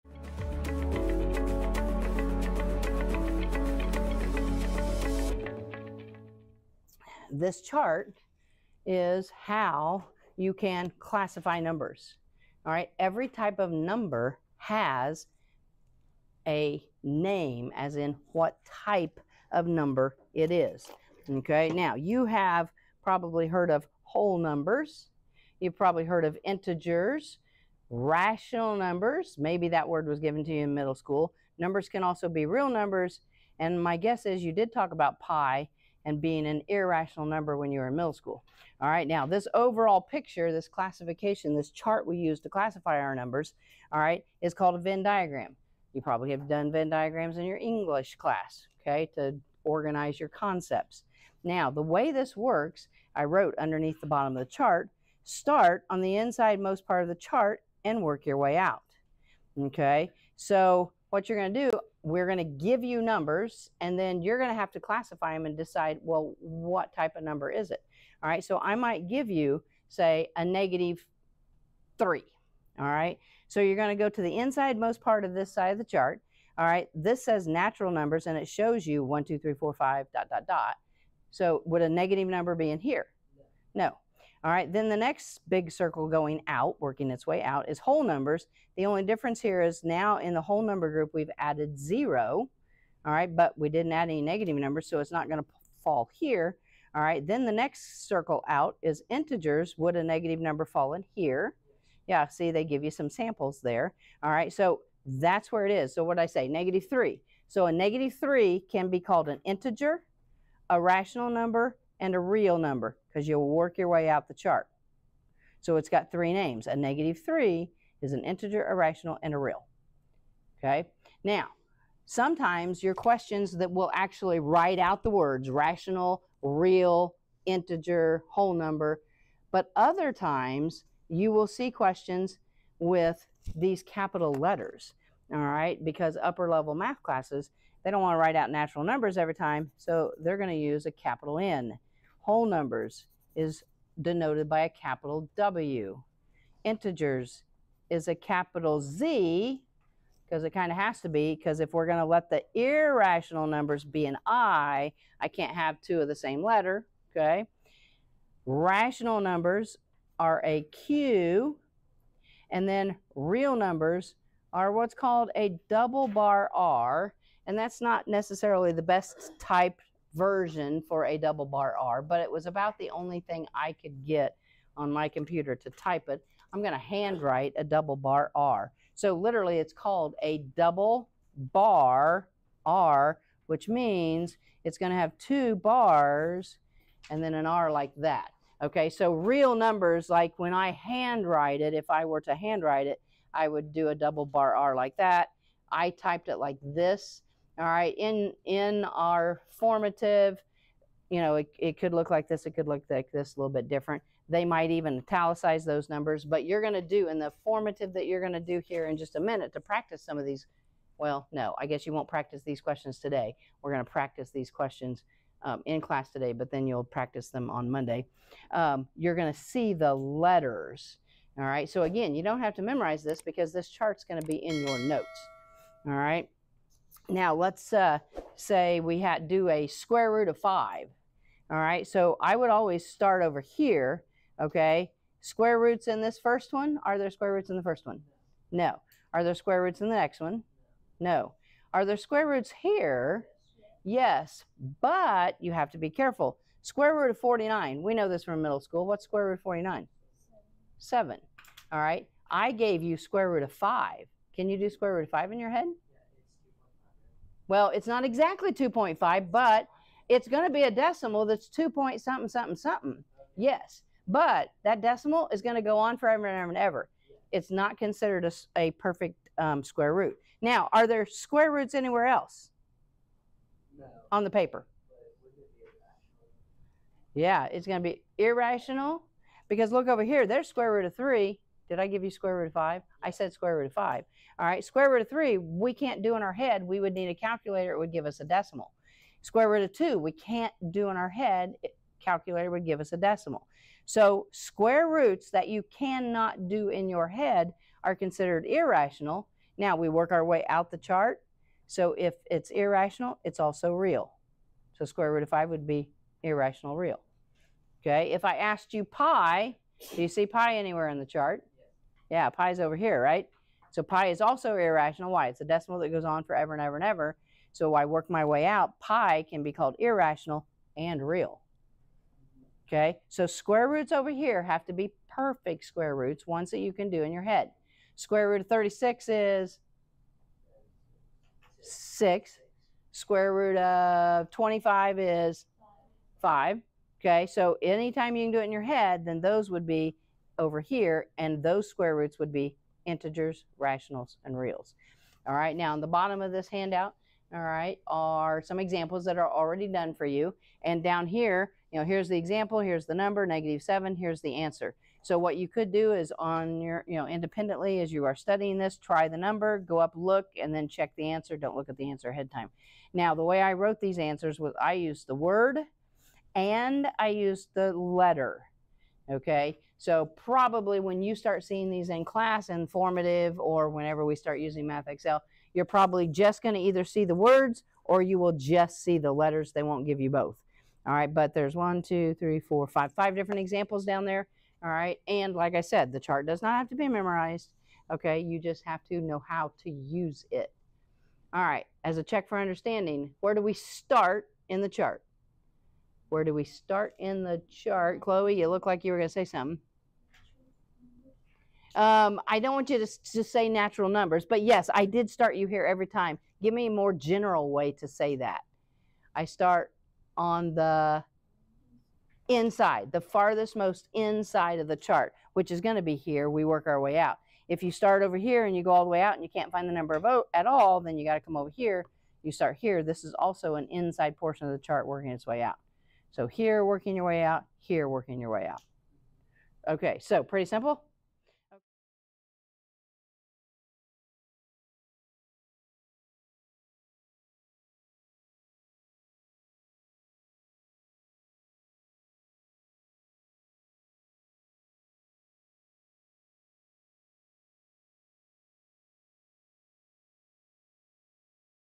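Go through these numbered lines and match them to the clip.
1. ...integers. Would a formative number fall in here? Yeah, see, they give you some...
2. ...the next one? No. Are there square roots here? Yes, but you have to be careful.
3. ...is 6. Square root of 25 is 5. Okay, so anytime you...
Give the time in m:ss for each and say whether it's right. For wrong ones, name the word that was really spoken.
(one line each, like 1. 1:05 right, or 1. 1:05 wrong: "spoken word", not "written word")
1. 1:39 wrong: "negative", not "formative"
2. 3:59 right
3. 5:29 right.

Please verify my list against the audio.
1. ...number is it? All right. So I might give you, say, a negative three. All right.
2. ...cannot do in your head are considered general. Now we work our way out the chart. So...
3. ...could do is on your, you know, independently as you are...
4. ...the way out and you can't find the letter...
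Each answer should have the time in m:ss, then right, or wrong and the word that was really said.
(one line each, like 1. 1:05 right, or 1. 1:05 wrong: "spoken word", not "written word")
1. 1:07 right
2. 4:55 wrong: "irrational", not "general"
3. 5:55 right
4. 6:58 wrong: "number", not "letter".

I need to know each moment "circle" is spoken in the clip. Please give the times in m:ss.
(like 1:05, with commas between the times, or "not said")
1:25, 1:38.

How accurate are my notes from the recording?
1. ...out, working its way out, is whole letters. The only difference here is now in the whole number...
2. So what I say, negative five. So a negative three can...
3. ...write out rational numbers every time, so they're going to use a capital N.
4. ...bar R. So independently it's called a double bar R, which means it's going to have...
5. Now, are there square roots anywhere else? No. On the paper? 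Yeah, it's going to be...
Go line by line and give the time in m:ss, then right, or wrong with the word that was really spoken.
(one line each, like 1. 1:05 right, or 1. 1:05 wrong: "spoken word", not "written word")
1. 1:26 wrong: "numbers", not "letters"
2. 1:45 wrong: "three", not "five"
3. 2:18 wrong: "natural", not "rational"
4. 2:57 wrong: "literally", not "independently"
5. 4:30 right.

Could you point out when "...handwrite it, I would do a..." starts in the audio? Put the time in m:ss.
3:12.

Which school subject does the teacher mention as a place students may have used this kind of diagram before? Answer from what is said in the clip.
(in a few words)
English class.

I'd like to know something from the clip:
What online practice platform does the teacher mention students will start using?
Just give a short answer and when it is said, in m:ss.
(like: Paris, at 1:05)
MathXL, at 6:14.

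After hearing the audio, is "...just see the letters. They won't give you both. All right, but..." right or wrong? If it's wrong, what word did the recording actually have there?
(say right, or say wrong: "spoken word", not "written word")
right.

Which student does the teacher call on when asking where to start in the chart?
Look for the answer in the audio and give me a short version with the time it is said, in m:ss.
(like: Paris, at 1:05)
Chloe, at 6:38.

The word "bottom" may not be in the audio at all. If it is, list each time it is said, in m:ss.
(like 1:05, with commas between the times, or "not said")
0:54, 5:45.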